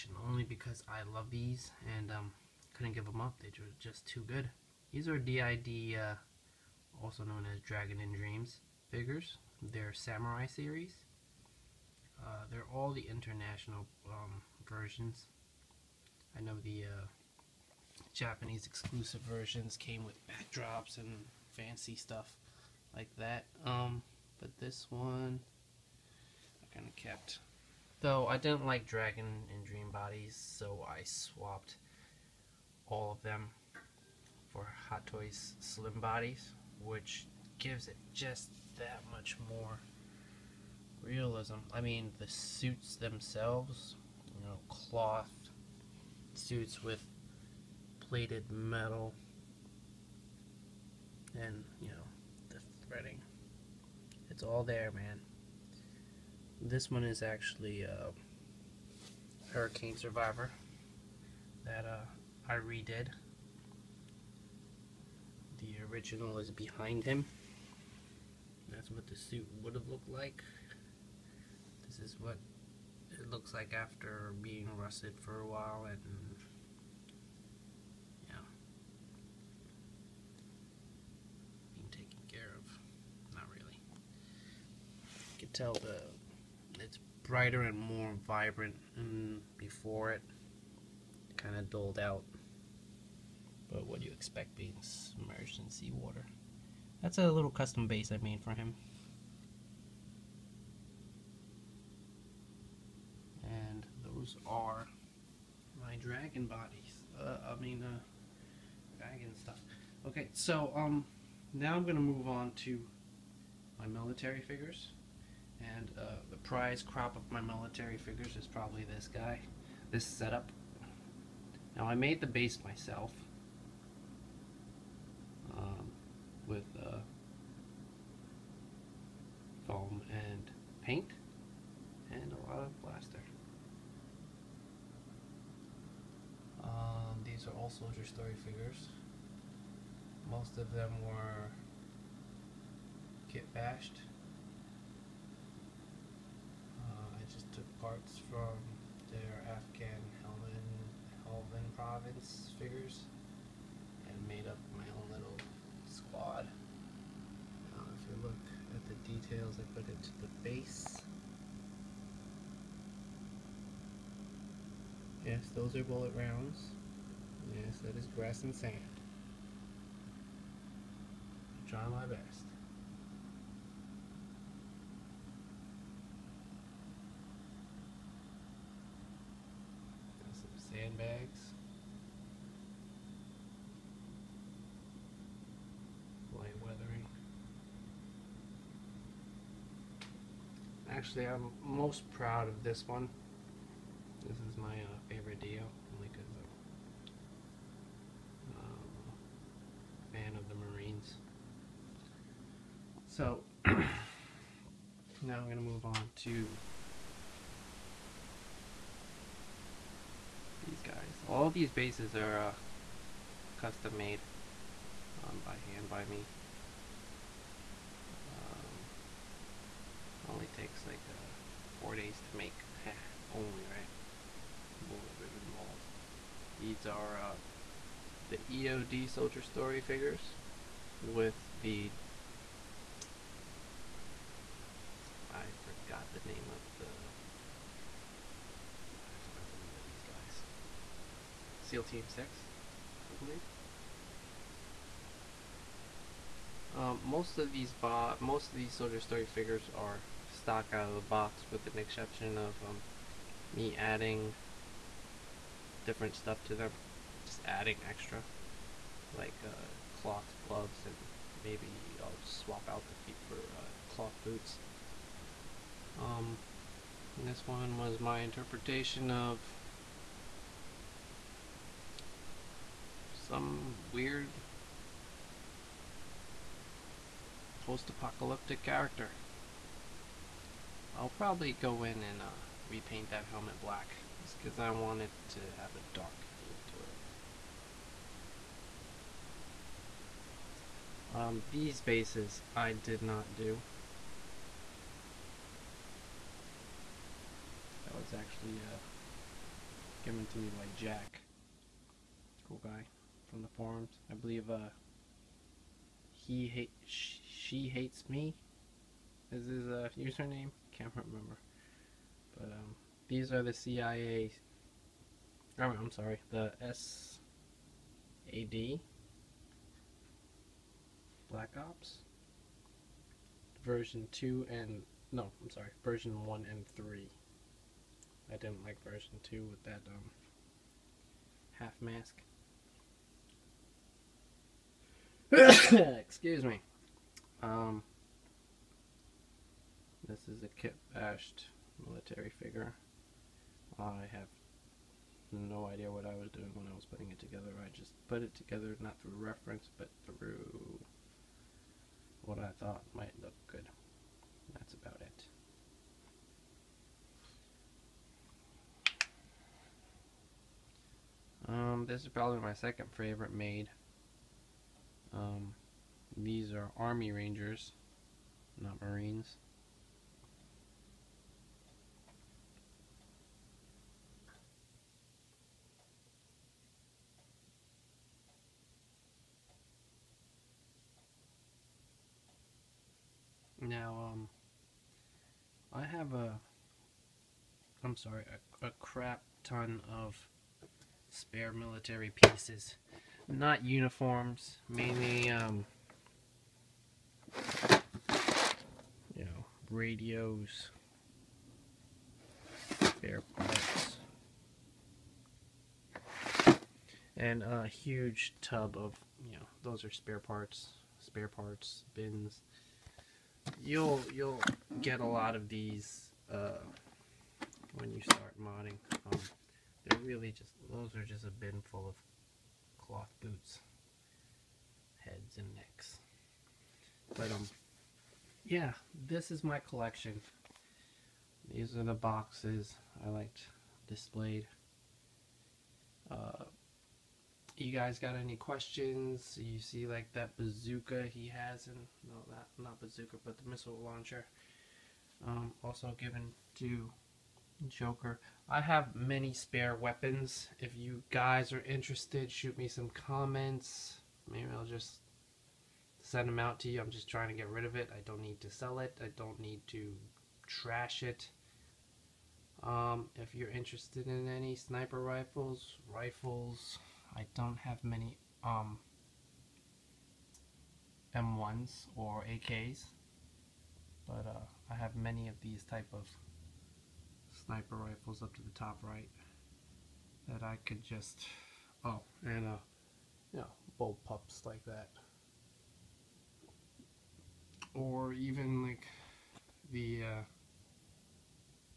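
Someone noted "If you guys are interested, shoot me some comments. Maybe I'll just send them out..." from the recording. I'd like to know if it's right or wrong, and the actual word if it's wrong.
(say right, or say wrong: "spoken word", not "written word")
right.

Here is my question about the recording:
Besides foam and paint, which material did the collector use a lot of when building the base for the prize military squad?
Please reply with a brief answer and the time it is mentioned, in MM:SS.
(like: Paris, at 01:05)
Plaster, at 02:12.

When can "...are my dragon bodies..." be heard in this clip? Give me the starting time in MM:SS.
01:44.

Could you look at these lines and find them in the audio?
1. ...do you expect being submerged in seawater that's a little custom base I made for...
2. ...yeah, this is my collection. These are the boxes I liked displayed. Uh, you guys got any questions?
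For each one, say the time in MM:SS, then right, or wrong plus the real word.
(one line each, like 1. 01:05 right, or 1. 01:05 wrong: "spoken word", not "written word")
1. 01:33 right
2. 07:08 right.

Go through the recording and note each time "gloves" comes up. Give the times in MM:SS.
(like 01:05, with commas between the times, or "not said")
04:20.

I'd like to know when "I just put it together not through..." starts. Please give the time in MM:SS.
05:47.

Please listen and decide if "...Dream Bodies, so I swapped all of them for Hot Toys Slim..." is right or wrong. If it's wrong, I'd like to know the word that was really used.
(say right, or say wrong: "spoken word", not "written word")
right.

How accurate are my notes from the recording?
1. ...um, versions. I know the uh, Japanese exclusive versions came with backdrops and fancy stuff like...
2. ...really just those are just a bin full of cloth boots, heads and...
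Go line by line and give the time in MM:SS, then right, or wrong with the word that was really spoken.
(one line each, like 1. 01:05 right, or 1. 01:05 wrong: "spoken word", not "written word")
1. 00:14 right
2. 06:59 right.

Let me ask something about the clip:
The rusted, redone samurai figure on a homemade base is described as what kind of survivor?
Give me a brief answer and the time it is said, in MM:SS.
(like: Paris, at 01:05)
Hurricane Survivor, at 00:59.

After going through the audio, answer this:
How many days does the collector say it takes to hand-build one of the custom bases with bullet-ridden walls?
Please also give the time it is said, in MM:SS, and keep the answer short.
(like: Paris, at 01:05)
4, at 03:41.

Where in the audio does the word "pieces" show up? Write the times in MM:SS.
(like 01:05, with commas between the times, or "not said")
06:32.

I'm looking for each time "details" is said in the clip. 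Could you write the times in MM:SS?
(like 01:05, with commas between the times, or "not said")
02:39.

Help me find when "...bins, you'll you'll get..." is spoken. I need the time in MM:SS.
06:51.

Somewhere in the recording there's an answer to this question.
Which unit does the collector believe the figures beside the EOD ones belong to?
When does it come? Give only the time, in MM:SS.
04:01.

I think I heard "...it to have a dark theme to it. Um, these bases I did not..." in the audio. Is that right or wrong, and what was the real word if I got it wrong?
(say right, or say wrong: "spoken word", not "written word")
right.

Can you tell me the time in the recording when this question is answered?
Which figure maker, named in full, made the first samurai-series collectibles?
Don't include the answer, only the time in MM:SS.
00:07.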